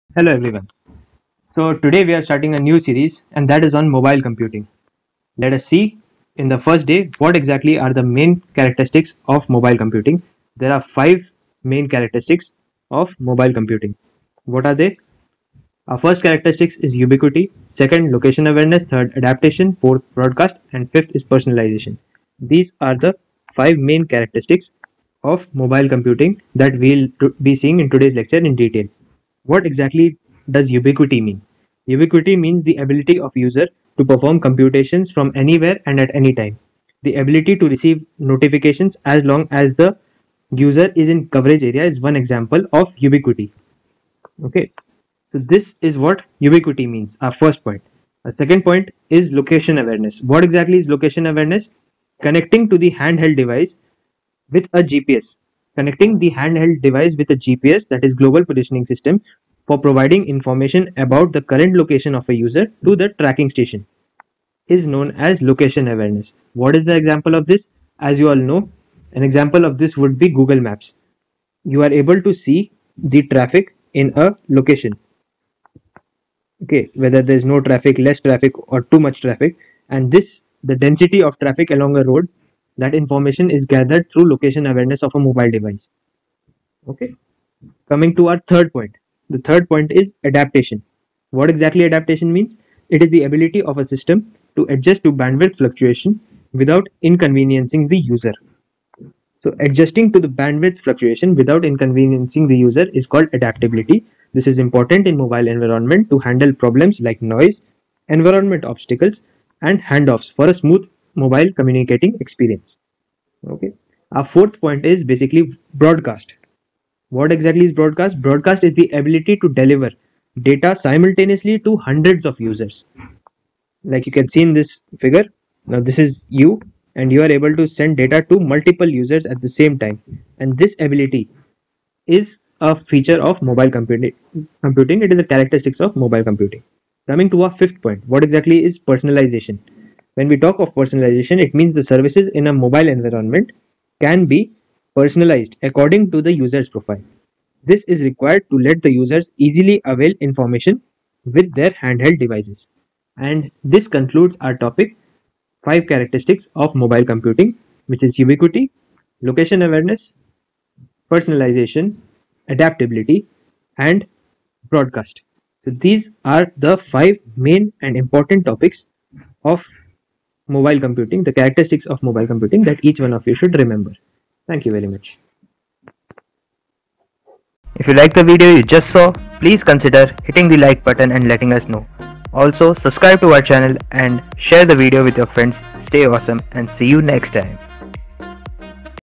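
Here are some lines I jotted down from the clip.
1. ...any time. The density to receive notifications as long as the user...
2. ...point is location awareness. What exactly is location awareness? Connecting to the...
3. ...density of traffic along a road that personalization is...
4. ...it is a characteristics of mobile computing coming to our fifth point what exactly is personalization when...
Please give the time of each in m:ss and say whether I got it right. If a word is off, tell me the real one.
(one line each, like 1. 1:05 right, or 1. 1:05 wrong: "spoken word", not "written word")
1. 0:36 wrong: "ability", not "density"
2. 0:48 right
3. 1:20 wrong: "information", not "personalization"
4. 2:15 right.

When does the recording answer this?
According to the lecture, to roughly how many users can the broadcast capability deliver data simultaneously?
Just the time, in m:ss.
2:01.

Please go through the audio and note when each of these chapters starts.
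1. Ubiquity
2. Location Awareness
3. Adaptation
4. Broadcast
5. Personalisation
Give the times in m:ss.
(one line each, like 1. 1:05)
1. 0:29
2. 0:47
3. 1:27
4. 1:53
5. 2:17.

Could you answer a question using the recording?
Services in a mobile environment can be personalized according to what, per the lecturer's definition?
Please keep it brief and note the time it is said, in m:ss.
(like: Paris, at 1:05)
the user's profile, at 2:26.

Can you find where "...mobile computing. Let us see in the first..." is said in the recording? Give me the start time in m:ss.
0:03.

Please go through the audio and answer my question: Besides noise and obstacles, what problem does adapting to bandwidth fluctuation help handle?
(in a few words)
handoffs.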